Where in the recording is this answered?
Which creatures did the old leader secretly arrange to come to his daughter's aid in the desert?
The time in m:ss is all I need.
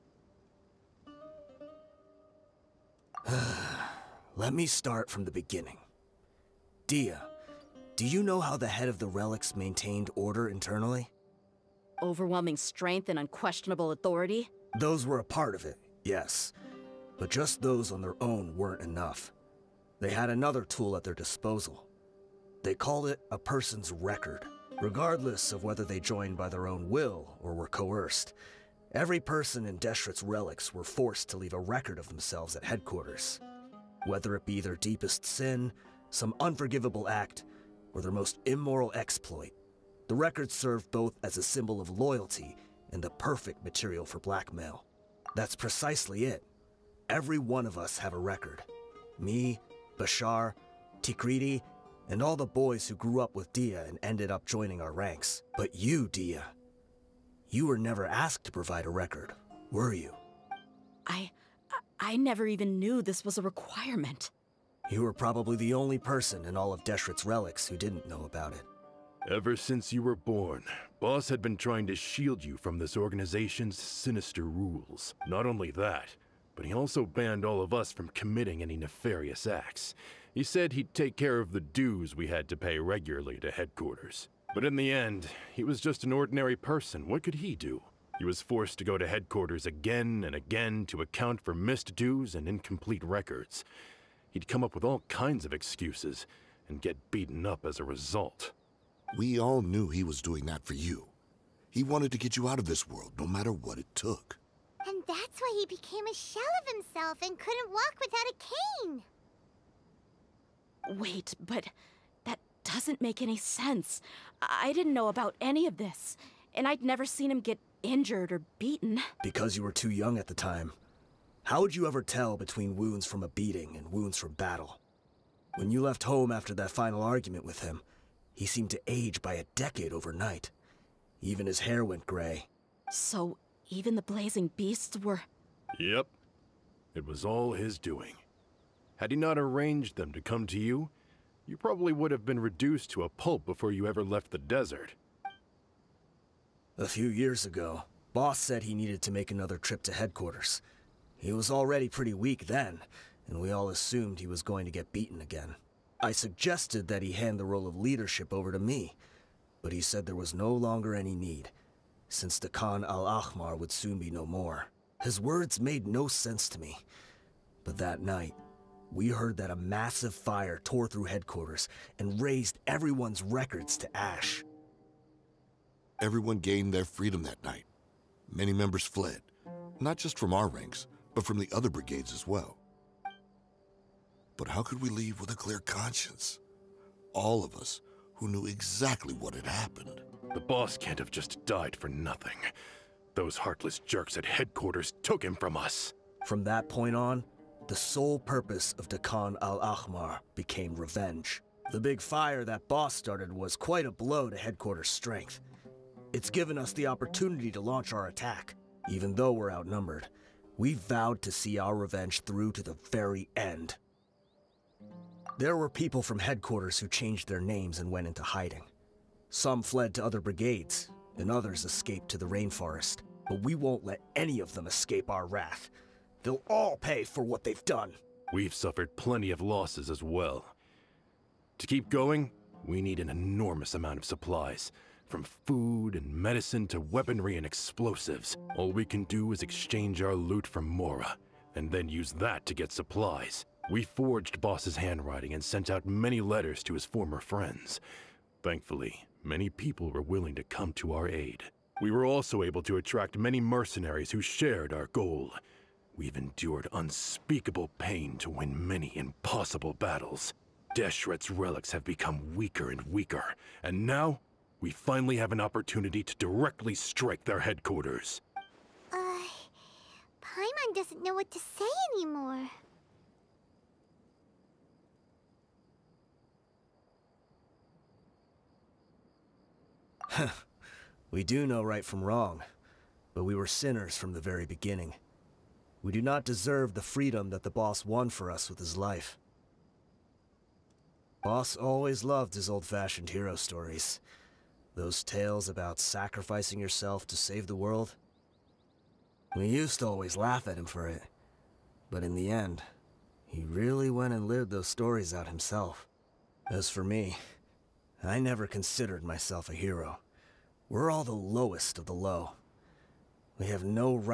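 2:14.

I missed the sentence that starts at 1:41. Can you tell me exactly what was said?
He wanted to get you out of this world, no matter what it took.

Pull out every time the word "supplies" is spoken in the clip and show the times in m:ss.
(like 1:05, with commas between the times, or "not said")
3:54, 4:02.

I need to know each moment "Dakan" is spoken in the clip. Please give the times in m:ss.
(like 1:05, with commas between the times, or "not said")
3:18.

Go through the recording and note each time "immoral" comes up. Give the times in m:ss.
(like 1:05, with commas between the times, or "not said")
0:38.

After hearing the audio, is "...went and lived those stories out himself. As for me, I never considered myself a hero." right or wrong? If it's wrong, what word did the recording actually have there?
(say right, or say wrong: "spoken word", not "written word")
right.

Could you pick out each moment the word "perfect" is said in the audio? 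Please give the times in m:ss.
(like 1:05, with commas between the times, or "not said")
0:43.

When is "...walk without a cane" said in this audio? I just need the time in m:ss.
1:47.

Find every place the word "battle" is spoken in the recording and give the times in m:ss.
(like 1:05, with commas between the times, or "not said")
2:04, 4:19.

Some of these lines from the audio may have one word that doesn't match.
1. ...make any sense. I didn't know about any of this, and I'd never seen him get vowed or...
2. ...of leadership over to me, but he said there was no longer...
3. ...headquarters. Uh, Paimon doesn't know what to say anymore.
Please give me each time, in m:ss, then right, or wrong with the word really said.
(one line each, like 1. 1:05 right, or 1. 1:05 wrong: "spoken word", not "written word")
1. 1:53 wrong: "injured", not "vowed"
2. 2:37 right
3. 4:27 right.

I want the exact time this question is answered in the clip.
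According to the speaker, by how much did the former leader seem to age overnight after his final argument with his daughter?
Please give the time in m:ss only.
2:09.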